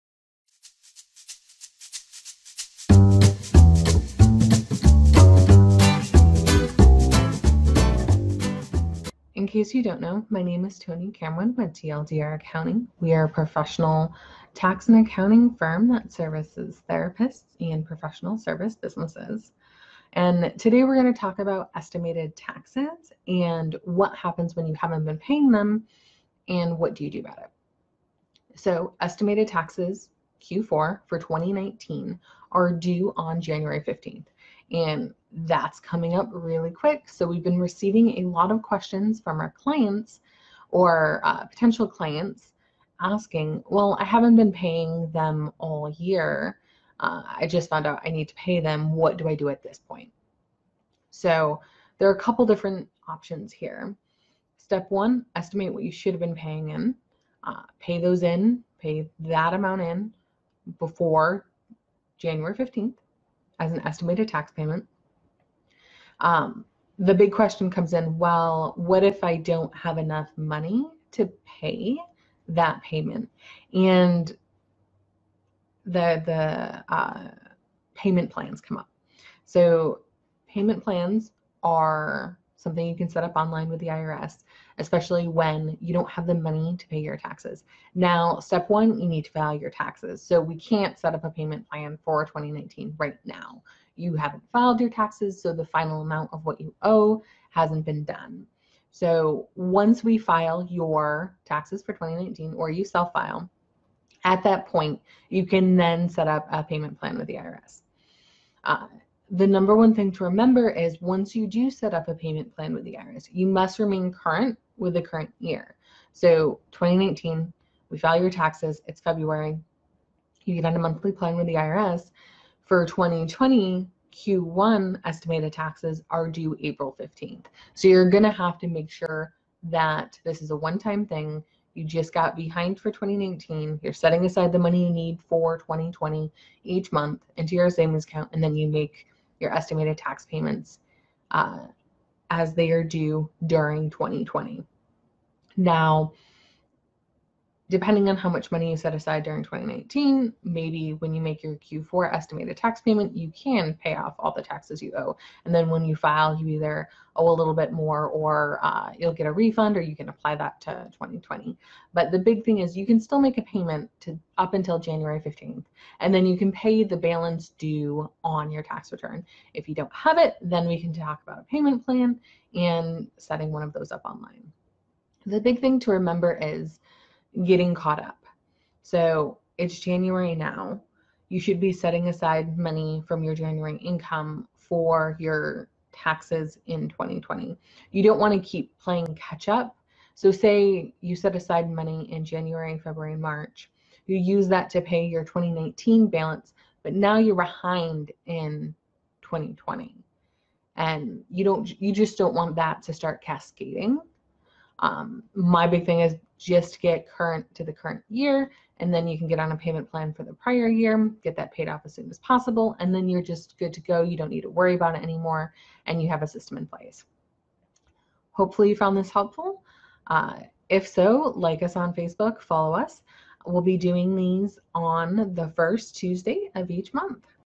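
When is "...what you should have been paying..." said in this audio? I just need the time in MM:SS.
00:55.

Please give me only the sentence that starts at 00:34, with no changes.
And that's coming up really quick.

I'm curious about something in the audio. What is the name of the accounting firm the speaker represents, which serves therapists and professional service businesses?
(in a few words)
TLDR Accounting.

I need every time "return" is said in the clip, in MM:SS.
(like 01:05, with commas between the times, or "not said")
02:48.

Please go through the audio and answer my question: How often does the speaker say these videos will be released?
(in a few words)
First Tuesday of each month.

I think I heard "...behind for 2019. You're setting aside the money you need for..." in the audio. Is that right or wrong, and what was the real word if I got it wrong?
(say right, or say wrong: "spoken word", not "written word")
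right.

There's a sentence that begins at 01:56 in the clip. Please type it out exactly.
So 2019, we file your taxes, it's February.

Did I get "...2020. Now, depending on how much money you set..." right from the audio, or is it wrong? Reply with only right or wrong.
right.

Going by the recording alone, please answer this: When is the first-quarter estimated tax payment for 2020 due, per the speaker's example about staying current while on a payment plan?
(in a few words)
April 15th.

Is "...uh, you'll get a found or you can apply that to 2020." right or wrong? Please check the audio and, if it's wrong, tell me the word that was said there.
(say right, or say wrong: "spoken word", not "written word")
wrong: "refund", not "found".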